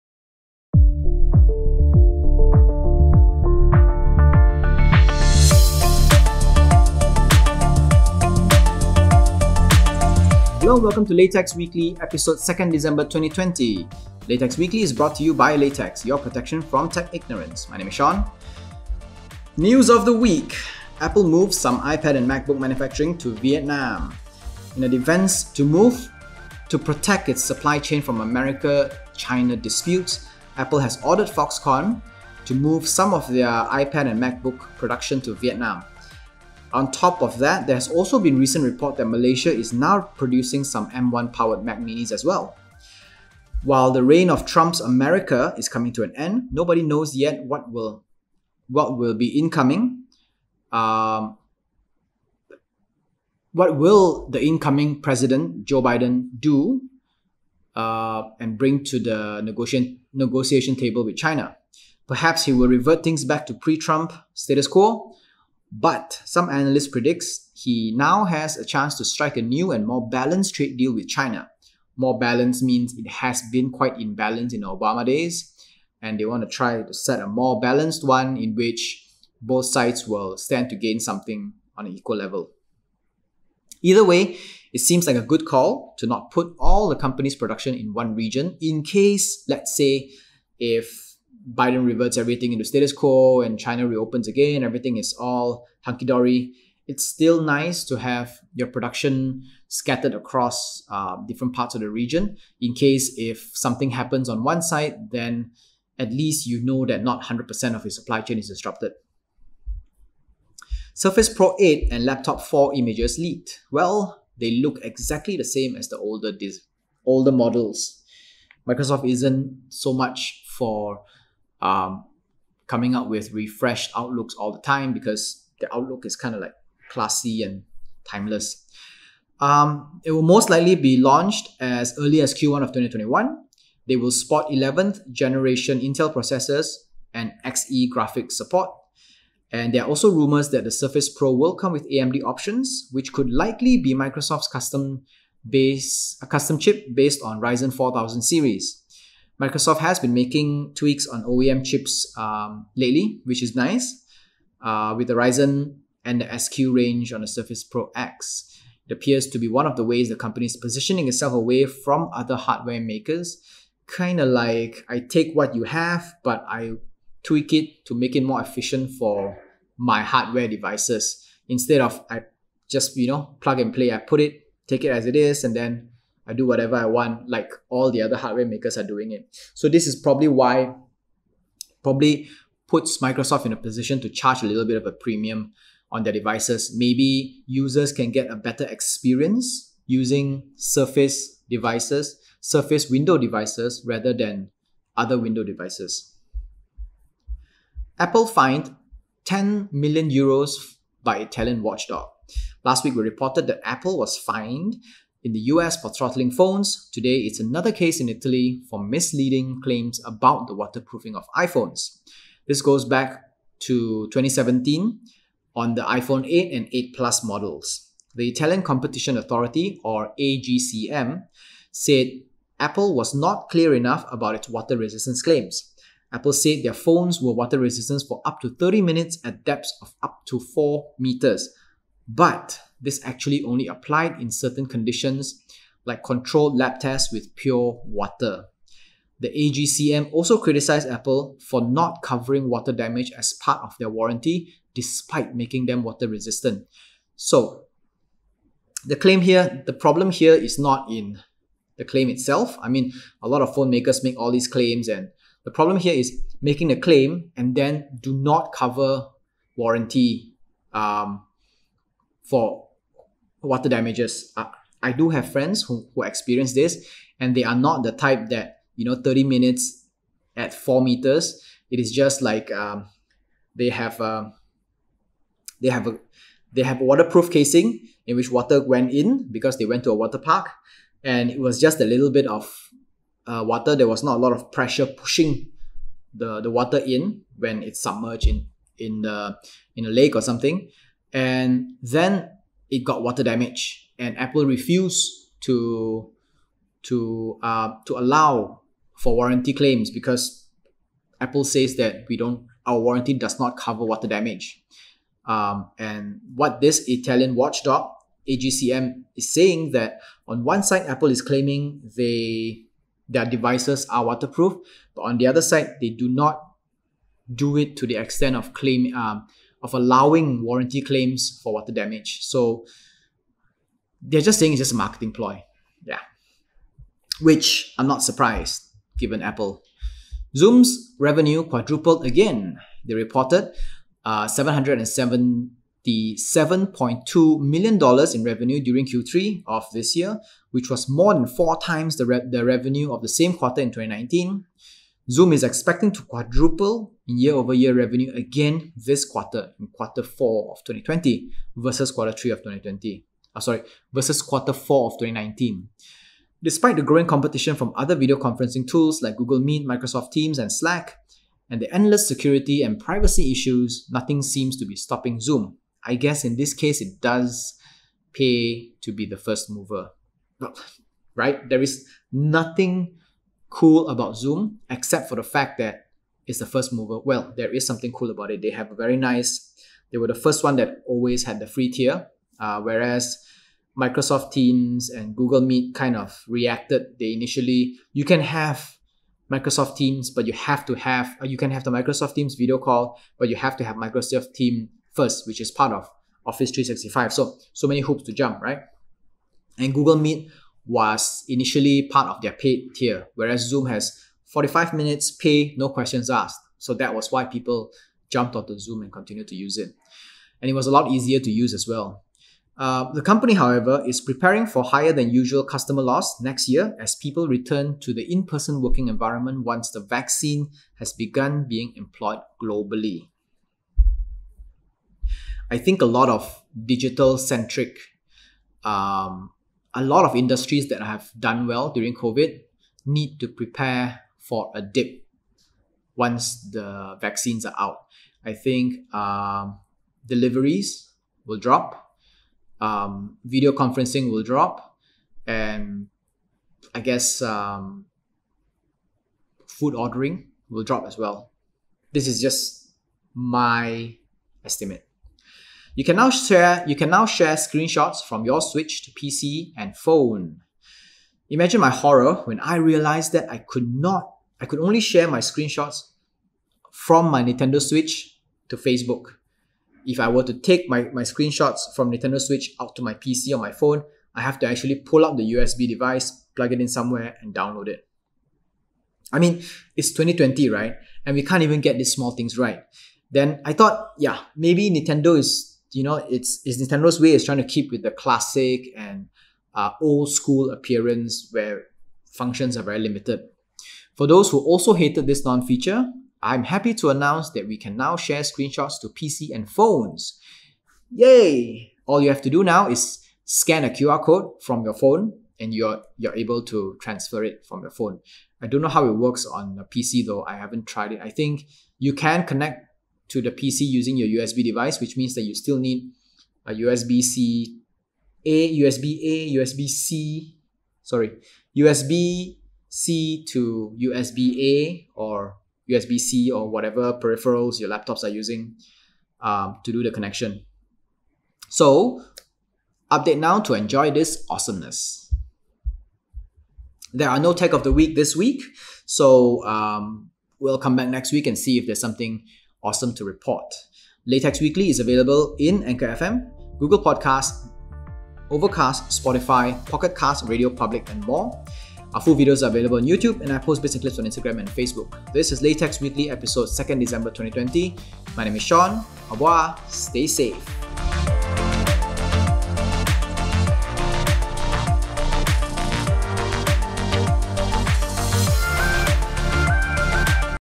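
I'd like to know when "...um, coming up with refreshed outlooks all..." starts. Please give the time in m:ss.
2:01.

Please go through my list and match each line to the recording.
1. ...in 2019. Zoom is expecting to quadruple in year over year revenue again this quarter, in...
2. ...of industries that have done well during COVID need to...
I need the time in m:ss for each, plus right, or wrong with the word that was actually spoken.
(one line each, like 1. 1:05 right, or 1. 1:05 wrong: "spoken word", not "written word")
1. 5:43 right
2. 7:10 right.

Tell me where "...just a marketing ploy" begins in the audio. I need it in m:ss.
5:24.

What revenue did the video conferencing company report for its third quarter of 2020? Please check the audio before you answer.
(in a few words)
$777.2 million.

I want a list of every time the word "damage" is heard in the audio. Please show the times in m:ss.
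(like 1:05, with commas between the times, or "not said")
4:02, 4:23, 4:53, 5:04, 5:21.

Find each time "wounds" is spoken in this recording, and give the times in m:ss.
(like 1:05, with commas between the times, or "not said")
not said.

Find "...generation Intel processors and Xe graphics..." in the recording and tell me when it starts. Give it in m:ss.
2:15.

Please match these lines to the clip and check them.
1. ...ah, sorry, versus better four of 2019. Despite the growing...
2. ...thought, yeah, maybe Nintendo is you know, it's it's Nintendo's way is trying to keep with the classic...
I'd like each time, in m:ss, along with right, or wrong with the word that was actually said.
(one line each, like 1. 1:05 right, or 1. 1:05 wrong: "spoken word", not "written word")
1. 5:53 wrong: "quarter", not "better"
2. 8:03 right.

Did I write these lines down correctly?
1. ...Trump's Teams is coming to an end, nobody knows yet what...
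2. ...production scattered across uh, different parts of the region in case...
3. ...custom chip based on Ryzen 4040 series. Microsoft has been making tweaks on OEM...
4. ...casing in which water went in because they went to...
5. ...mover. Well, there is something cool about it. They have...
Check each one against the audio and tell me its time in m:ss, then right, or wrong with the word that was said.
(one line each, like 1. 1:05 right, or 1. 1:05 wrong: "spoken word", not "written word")
1. 0:44 wrong: "America", not "Teams"
2. 1:38 right
3. 2:26 wrong: "4000", not "4040"
4. 4:37 right
5. 6:16 right.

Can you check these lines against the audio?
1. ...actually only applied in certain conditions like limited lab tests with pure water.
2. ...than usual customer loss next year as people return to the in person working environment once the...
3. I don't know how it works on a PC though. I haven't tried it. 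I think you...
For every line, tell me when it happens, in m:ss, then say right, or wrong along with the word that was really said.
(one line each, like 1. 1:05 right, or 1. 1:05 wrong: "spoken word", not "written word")
1. 3:53 wrong: "controlled", not "limited"
2. 6:54 right
3. 8:28 right.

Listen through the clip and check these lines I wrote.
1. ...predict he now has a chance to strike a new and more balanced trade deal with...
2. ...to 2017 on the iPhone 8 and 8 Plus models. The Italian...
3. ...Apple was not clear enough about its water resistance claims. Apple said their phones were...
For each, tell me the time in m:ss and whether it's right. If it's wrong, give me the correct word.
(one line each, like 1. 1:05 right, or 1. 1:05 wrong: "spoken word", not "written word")
1. 1:06 right
2. 3:33 right
3. 3:42 right.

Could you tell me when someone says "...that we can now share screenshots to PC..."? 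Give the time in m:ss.
8:17.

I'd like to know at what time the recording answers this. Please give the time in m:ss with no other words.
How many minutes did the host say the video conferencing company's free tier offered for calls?
6:44.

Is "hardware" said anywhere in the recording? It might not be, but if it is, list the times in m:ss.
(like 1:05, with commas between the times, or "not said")
2:42, 2:50, 2:58.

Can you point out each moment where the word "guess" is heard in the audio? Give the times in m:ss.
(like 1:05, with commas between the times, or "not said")
6:05, 7:26.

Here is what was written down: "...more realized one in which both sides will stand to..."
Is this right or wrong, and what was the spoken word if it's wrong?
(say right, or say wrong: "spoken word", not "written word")
wrong: "balanced", not "realized".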